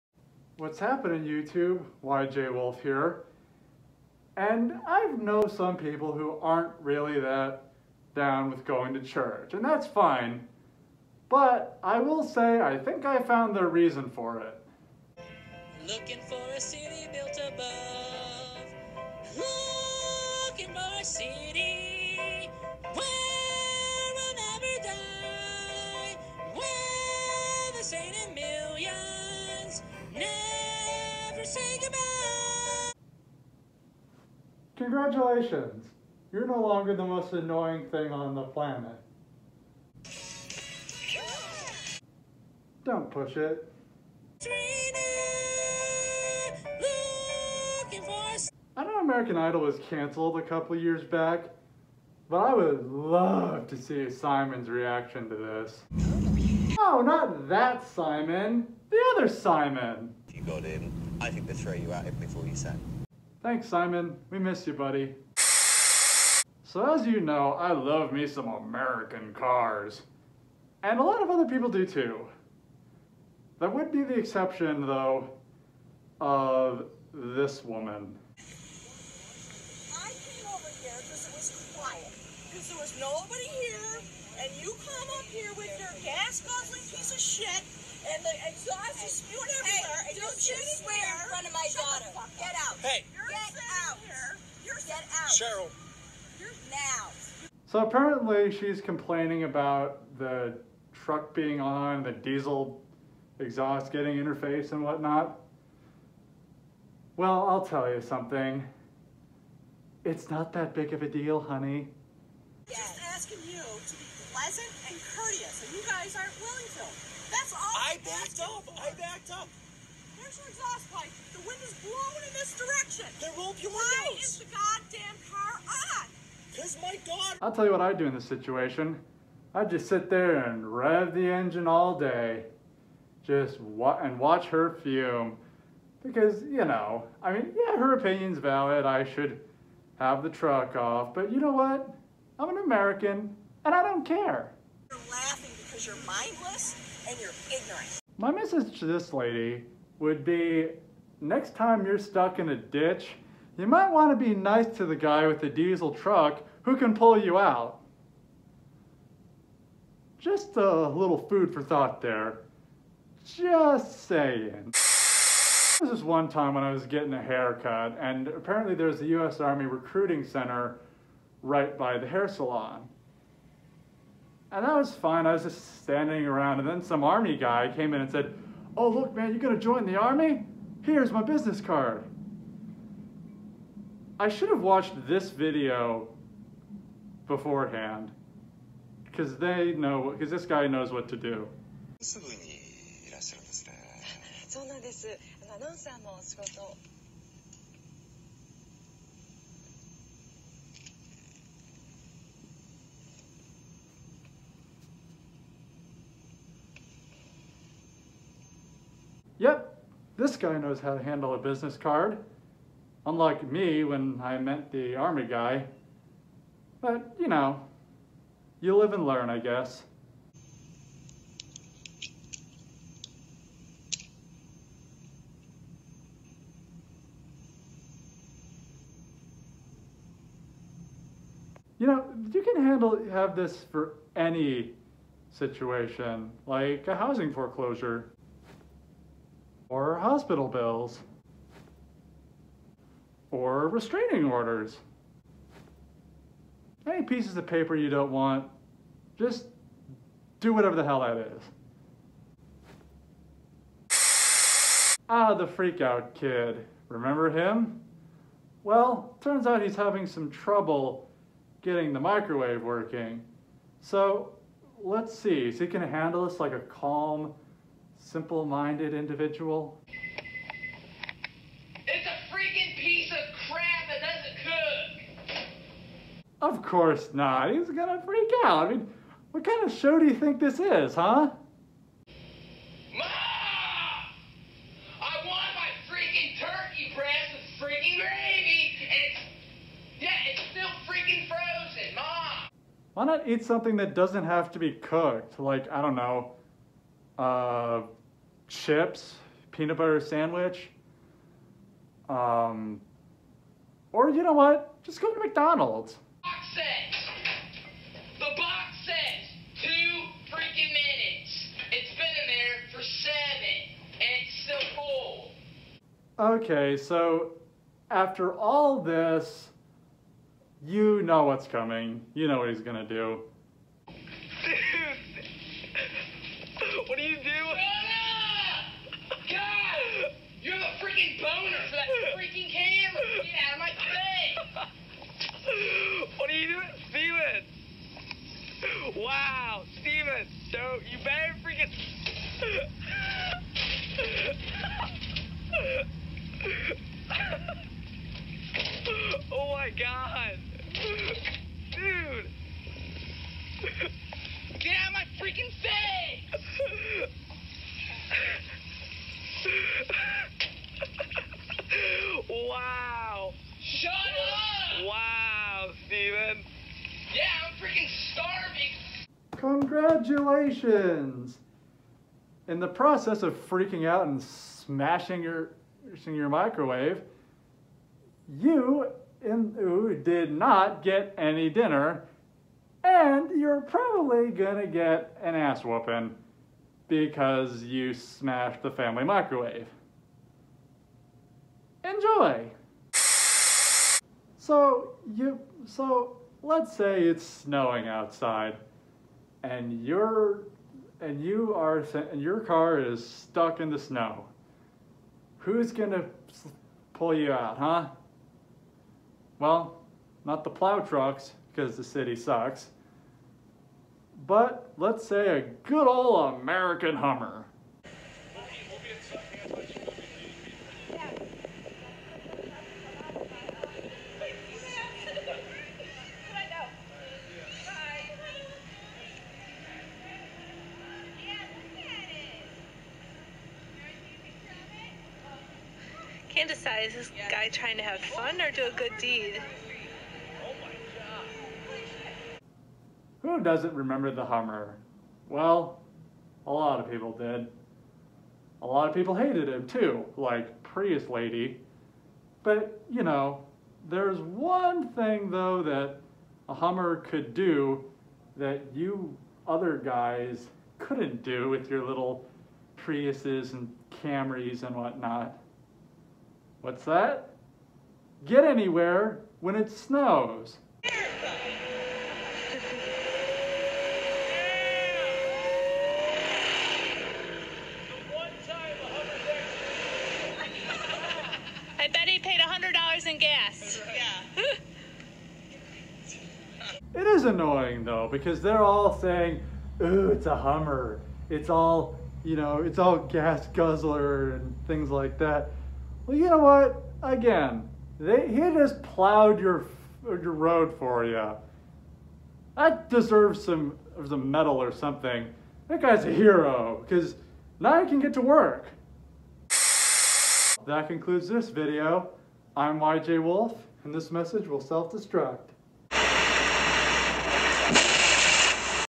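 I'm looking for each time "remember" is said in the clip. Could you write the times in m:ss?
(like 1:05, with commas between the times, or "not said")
4:16, 7:23.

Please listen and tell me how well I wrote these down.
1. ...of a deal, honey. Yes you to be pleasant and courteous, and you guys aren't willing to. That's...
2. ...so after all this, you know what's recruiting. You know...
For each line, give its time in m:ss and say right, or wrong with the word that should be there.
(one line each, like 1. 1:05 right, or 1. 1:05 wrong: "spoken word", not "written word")
1. 1:50 right
2. 5:16 wrong: "coming", not "recruiting".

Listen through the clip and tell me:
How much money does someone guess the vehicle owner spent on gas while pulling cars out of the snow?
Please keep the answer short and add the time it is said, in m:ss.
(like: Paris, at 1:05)
$100, at 8:02.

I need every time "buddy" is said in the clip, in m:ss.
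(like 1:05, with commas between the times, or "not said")
1:04.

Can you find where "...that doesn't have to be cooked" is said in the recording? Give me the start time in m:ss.
4:53.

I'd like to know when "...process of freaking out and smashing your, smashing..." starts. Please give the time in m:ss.
6:12.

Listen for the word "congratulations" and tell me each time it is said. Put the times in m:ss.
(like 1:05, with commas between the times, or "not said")
0:34, 6:09.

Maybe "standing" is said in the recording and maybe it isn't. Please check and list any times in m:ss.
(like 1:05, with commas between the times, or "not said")
2:55.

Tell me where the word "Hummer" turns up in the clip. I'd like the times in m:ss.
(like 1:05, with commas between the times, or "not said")
6:56, 7:24, 7:36, 8:10.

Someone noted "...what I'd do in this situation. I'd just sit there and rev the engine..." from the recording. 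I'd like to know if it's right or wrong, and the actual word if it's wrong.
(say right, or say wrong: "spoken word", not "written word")
right.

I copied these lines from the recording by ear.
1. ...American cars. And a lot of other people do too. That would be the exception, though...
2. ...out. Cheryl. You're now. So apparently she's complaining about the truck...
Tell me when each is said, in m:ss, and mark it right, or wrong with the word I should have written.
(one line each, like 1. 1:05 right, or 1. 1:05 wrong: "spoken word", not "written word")
1. 1:08 right
2. 1:35 right.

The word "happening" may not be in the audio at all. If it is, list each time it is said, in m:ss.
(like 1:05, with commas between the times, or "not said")
0:00.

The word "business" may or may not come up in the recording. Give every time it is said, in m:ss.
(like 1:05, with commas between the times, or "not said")
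3:01, 3:31.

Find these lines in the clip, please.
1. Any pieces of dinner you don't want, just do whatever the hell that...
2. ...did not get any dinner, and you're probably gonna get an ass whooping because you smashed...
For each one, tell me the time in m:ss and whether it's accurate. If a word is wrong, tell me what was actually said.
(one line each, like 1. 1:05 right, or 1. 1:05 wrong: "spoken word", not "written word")
1. 4:06 wrong: "paper", not "dinner"
2. 6:20 right.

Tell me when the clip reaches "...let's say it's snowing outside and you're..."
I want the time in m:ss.
6:36.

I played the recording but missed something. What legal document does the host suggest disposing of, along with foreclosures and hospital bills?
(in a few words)
restraining orders.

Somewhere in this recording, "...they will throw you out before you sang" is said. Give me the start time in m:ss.
1:01.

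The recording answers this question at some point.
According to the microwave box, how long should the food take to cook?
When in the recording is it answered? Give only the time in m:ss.
5:09.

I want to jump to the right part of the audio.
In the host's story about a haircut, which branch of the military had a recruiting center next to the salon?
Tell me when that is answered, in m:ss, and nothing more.
2:49.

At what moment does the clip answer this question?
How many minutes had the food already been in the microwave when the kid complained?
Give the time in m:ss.
5:12.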